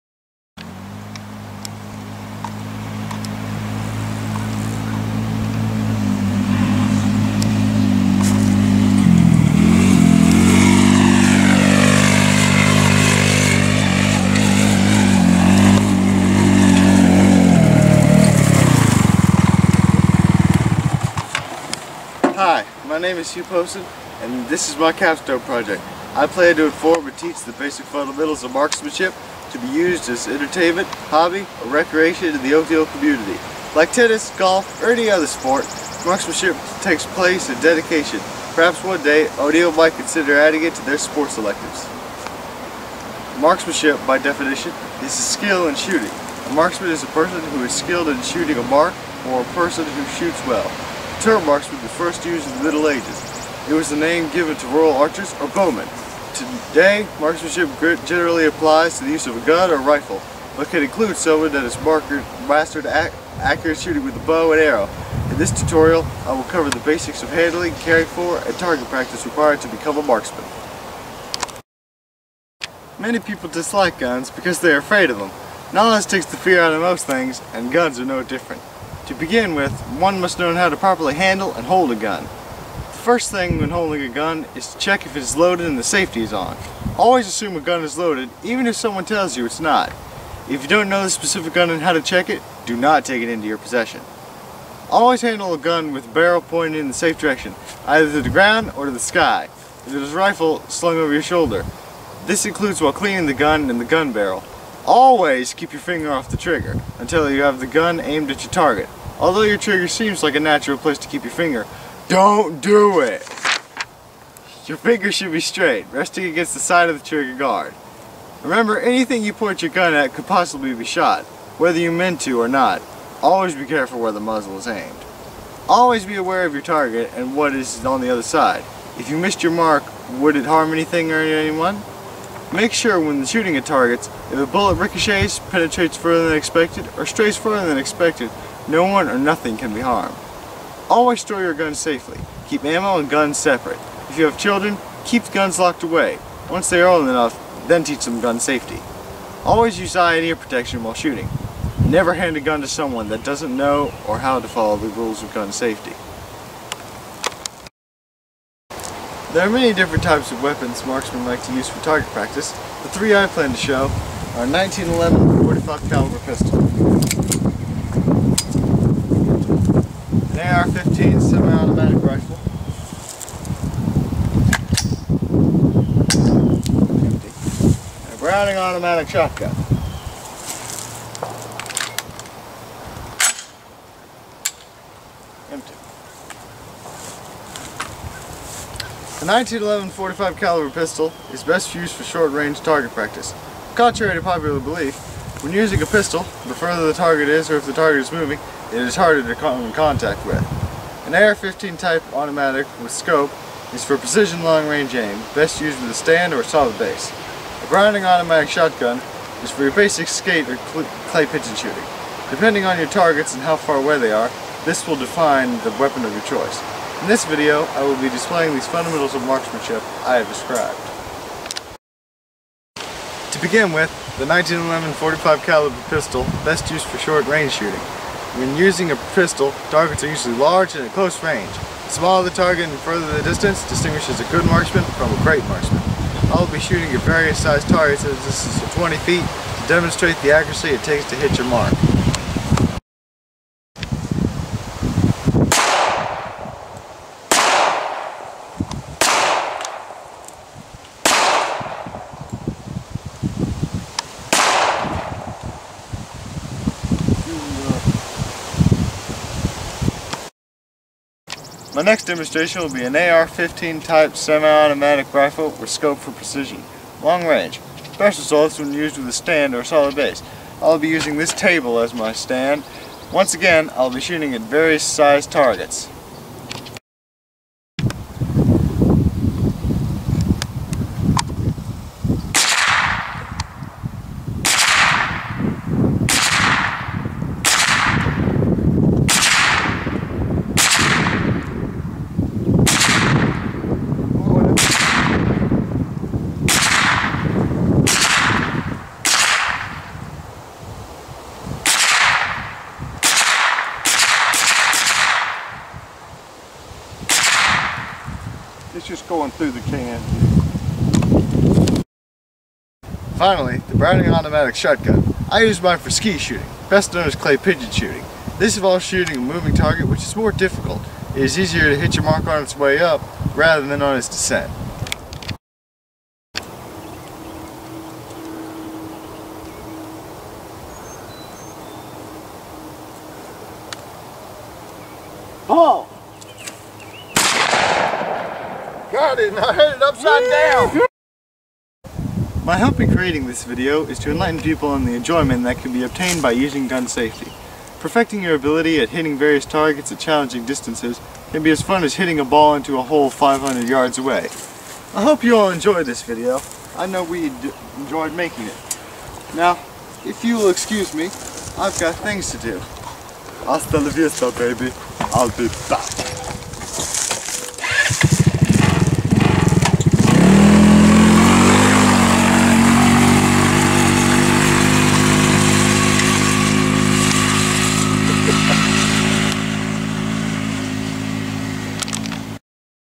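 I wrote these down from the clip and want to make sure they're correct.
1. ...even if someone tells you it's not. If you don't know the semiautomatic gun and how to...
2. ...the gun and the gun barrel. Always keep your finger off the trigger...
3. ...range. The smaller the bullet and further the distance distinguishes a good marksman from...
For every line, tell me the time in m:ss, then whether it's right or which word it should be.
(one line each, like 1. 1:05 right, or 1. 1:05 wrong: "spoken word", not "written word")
1. 1:28 wrong: "specific", not "semiautomatic"
2. 1:43 right
3. 3:51 wrong: "target", not "bullet".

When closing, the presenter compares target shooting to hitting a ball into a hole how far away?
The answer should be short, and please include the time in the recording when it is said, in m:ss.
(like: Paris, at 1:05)
500 yards, at 5:53.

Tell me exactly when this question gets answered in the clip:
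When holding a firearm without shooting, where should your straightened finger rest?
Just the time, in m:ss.
1:56.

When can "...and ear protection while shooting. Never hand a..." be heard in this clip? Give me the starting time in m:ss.
2:30.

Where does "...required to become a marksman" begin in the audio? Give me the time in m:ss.
1:09.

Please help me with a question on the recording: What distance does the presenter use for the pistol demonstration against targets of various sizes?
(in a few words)
20 feet.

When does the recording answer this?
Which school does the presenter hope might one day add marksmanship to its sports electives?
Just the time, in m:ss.
0:39.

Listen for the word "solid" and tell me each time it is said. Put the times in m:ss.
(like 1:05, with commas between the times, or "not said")
3:26, 4:29.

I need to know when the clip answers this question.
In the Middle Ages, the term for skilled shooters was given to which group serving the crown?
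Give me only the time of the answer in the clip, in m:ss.
0:54.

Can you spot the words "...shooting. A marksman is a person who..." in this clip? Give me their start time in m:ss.
0:45.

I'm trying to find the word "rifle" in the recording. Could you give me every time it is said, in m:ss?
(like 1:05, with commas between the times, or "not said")
0:59, 1:40, 2:52, 4:25.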